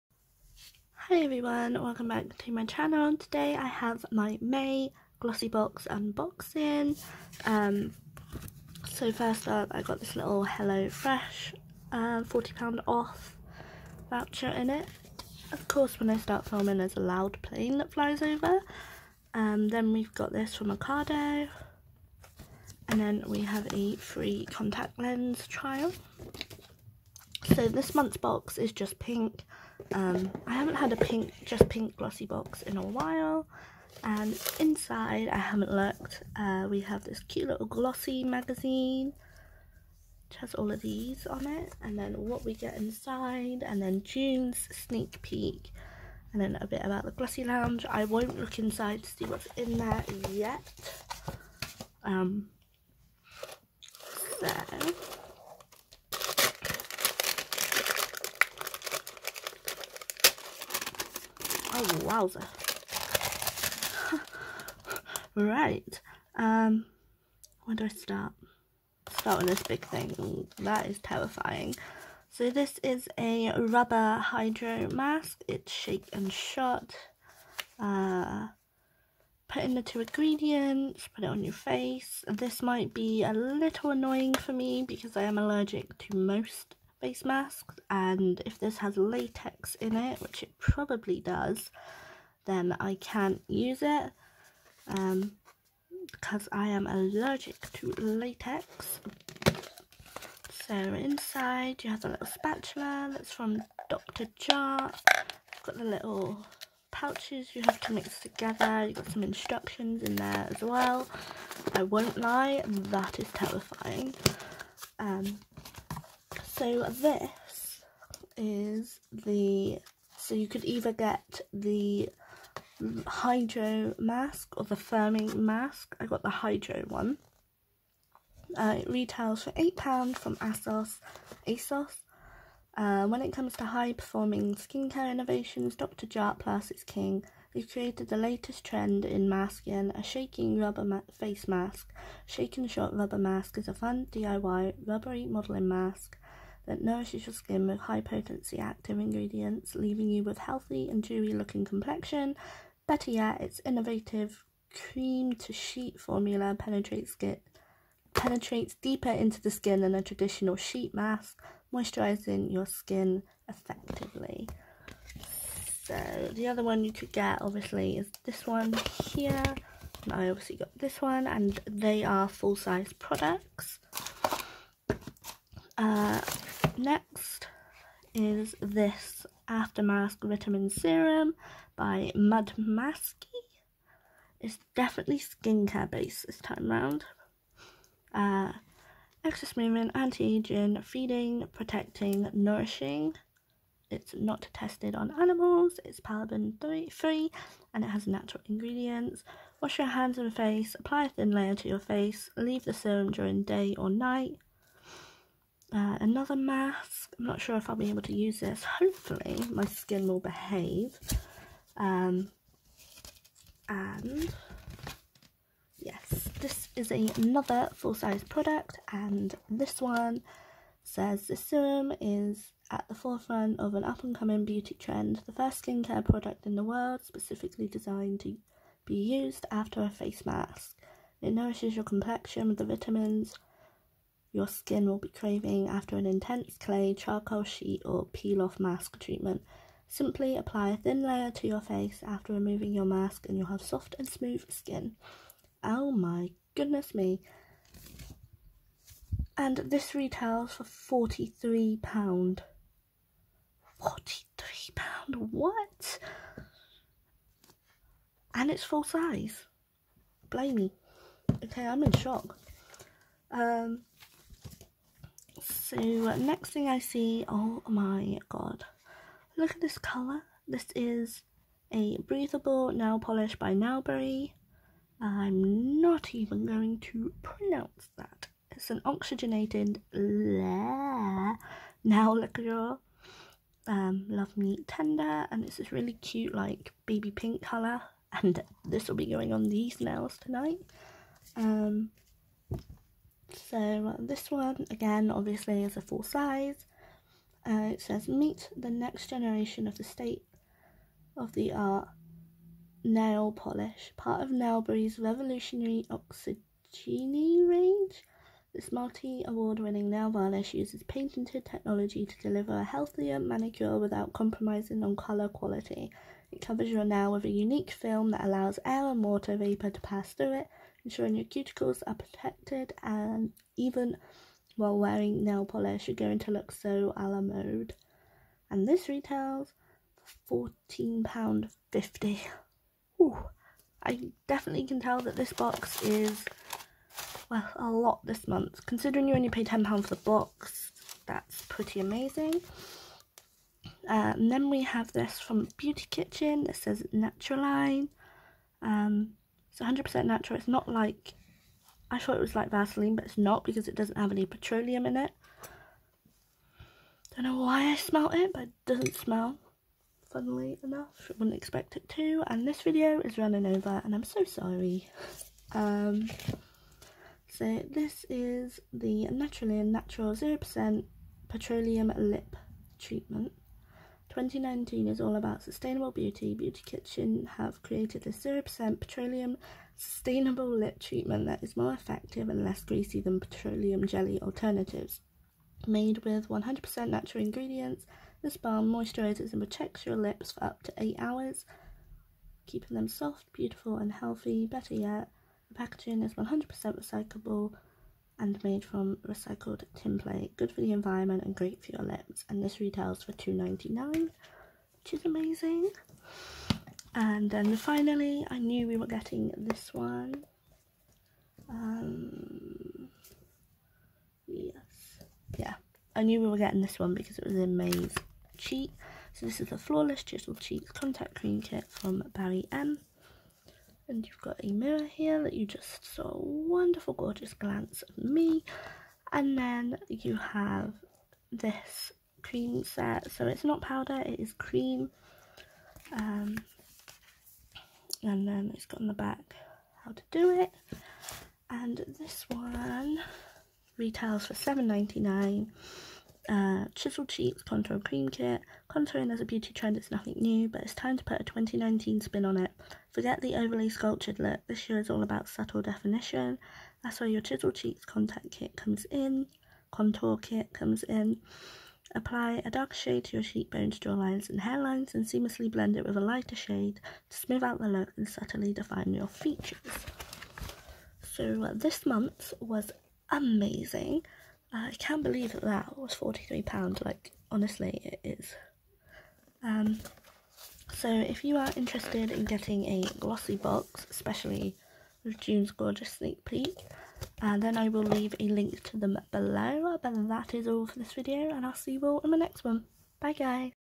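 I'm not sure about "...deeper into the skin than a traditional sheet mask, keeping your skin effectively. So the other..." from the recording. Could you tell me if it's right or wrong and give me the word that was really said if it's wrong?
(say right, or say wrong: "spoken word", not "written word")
wrong: "moisturizing", not "keeping".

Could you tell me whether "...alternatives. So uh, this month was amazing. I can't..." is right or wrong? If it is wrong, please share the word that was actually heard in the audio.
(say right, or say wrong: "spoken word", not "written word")
wrong: "features", not "alternatives".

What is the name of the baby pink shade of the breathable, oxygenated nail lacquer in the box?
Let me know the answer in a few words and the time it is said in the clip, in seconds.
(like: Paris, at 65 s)
Love Me Tender, at 284 s.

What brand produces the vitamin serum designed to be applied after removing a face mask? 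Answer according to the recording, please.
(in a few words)
Mud Masky.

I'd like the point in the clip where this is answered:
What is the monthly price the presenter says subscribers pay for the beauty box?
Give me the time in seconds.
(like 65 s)
339 s.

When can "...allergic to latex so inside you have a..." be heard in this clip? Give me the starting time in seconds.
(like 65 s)
96 s.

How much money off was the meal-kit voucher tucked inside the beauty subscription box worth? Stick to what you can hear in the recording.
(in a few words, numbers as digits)
£40.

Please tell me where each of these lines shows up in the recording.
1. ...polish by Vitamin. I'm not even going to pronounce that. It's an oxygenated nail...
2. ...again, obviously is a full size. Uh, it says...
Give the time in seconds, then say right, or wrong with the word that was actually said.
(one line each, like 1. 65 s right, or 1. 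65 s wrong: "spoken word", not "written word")
1. 272 s wrong: "Nailberry", not "Vitamin"
2. 294 s right.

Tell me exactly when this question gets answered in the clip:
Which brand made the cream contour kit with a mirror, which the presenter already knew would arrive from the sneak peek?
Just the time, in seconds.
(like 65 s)
422 s.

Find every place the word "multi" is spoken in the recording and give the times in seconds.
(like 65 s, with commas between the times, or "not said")
308 s.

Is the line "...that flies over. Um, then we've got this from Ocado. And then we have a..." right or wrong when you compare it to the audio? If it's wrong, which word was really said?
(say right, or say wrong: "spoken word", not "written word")
right.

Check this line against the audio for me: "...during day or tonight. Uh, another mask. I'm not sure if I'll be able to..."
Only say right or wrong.
wrong.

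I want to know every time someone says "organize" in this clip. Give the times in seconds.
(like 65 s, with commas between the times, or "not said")
not said.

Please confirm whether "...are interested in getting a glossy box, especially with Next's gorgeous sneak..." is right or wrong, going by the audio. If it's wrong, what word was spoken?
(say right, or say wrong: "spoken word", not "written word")
wrong: "June", not "Next".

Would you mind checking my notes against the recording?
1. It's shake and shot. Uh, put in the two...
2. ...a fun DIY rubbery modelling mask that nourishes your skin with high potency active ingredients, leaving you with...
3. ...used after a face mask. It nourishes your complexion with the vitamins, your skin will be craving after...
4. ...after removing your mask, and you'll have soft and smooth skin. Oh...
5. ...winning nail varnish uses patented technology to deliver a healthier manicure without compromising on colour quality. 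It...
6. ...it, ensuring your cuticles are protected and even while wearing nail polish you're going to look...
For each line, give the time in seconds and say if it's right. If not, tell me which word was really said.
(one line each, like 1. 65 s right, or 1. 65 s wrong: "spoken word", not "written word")
1. 75 s right
2. 143 s right
3. 228 s right
4. 242 s right
5. 309 s right
6. 320 s right.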